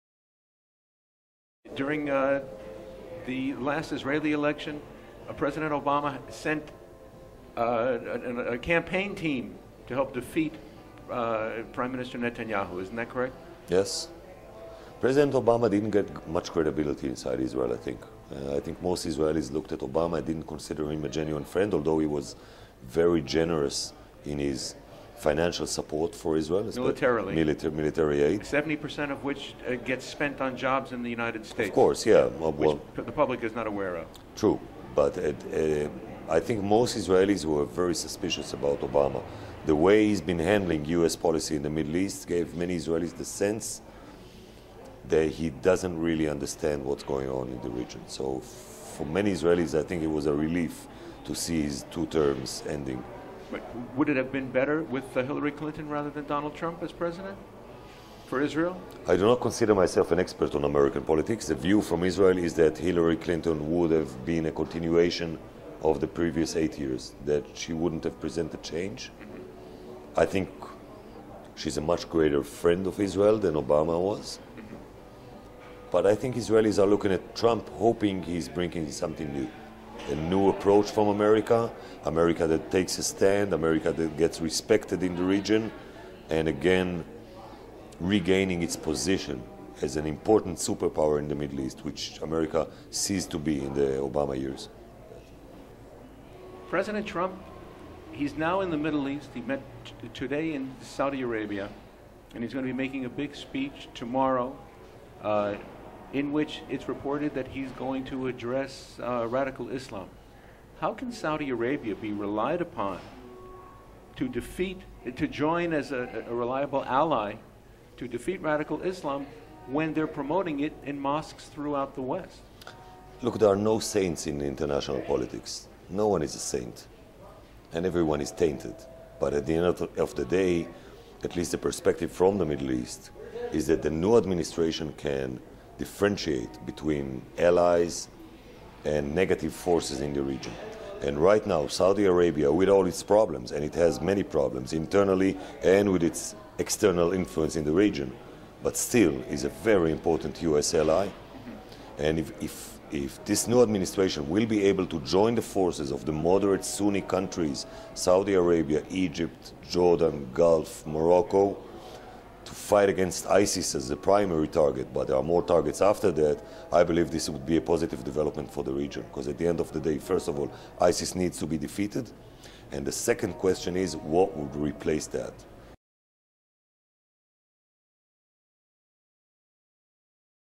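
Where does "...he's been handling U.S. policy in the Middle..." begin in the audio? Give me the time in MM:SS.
00:40.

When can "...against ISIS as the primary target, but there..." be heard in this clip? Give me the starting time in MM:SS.
02:42.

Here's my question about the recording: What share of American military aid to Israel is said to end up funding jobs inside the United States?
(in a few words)
70%.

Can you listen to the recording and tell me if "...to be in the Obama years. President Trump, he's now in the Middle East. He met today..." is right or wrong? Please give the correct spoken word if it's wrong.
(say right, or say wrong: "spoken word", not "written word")
right.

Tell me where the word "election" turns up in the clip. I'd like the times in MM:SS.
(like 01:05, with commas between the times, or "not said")
00:04.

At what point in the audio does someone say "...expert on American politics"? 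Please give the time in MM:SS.
01:00.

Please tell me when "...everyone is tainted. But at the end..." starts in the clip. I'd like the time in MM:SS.
02:07.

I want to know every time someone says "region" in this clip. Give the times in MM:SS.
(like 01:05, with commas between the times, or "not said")
00:47, 01:25, 02:20, 02:27, 02:48.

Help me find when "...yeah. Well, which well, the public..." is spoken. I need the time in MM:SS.
00:32.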